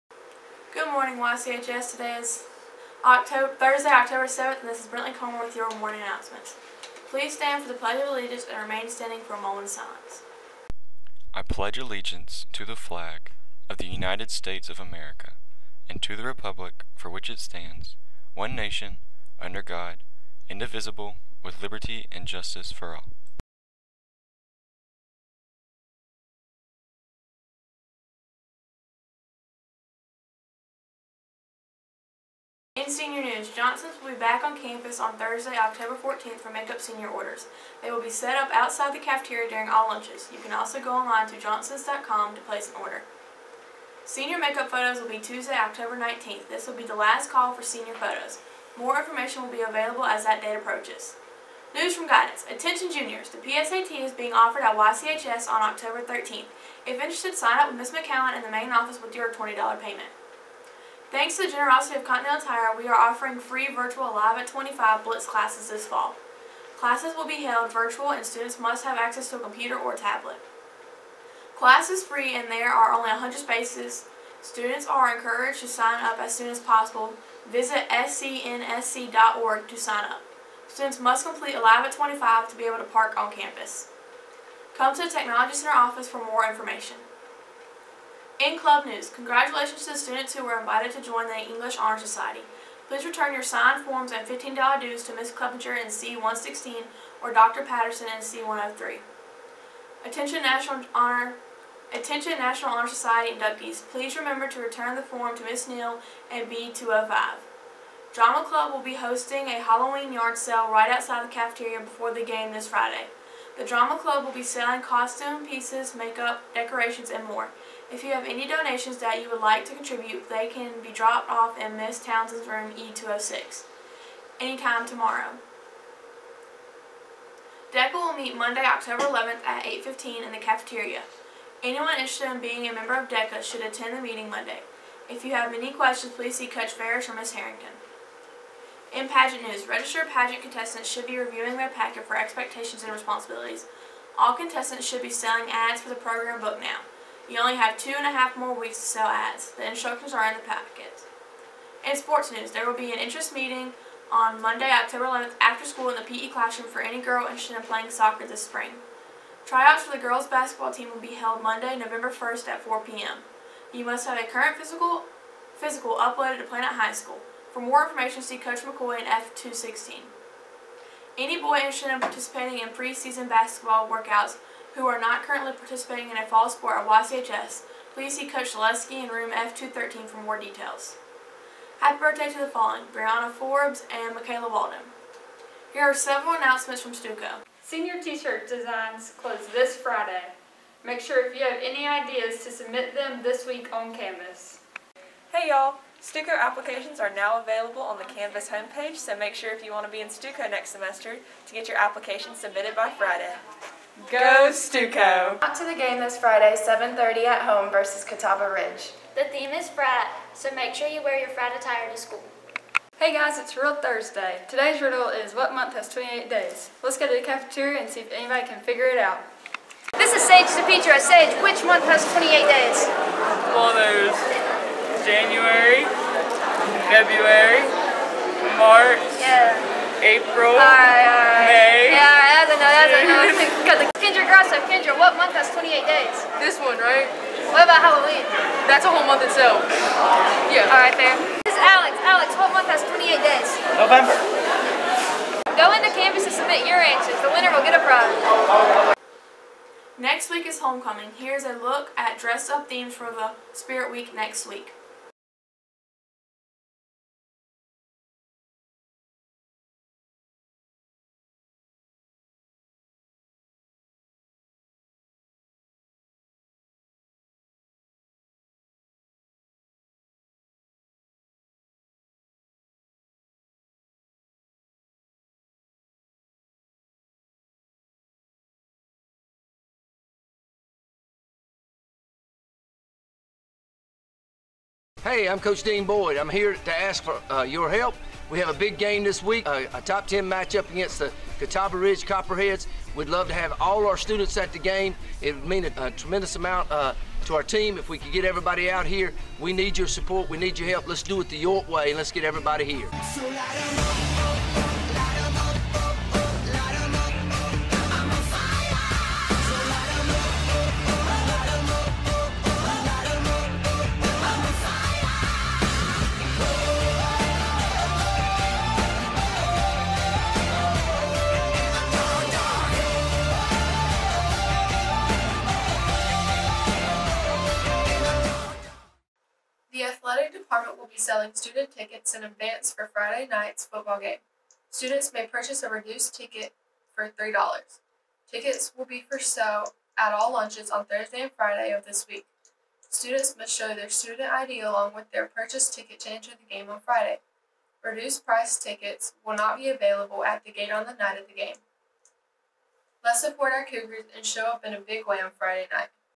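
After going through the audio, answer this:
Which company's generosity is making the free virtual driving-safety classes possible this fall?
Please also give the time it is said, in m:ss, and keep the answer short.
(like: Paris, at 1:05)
Continental Tire, at 1:02.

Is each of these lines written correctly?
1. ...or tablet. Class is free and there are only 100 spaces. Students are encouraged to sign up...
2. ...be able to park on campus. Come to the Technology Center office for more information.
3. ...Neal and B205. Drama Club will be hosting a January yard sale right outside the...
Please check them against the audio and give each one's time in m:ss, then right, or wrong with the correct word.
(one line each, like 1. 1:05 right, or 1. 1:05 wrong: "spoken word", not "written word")
1. 1:09 right
2. 1:22 right
3. 1:45 wrong: "Halloween", not "January".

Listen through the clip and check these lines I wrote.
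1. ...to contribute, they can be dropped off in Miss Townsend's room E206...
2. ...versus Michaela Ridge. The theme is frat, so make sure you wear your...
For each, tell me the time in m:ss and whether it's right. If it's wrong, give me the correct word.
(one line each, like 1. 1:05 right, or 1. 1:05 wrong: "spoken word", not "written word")
1. 1:59 right
2. 3:27 wrong: "Catawba", not "Michaela".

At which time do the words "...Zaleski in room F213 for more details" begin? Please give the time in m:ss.
2:58.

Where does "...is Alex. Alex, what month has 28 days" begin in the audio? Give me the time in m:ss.
4:01.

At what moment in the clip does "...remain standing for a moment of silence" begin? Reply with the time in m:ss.
0:08.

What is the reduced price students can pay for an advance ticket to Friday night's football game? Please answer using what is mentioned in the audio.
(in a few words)
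$3.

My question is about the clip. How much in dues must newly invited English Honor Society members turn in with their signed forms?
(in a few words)
$15.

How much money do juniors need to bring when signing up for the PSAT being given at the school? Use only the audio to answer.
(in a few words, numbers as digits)
$20.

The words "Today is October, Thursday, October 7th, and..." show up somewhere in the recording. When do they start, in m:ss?
0:01.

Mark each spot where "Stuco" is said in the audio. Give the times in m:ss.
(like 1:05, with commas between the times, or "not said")
3:06, 3:16, 3:20, 3:24.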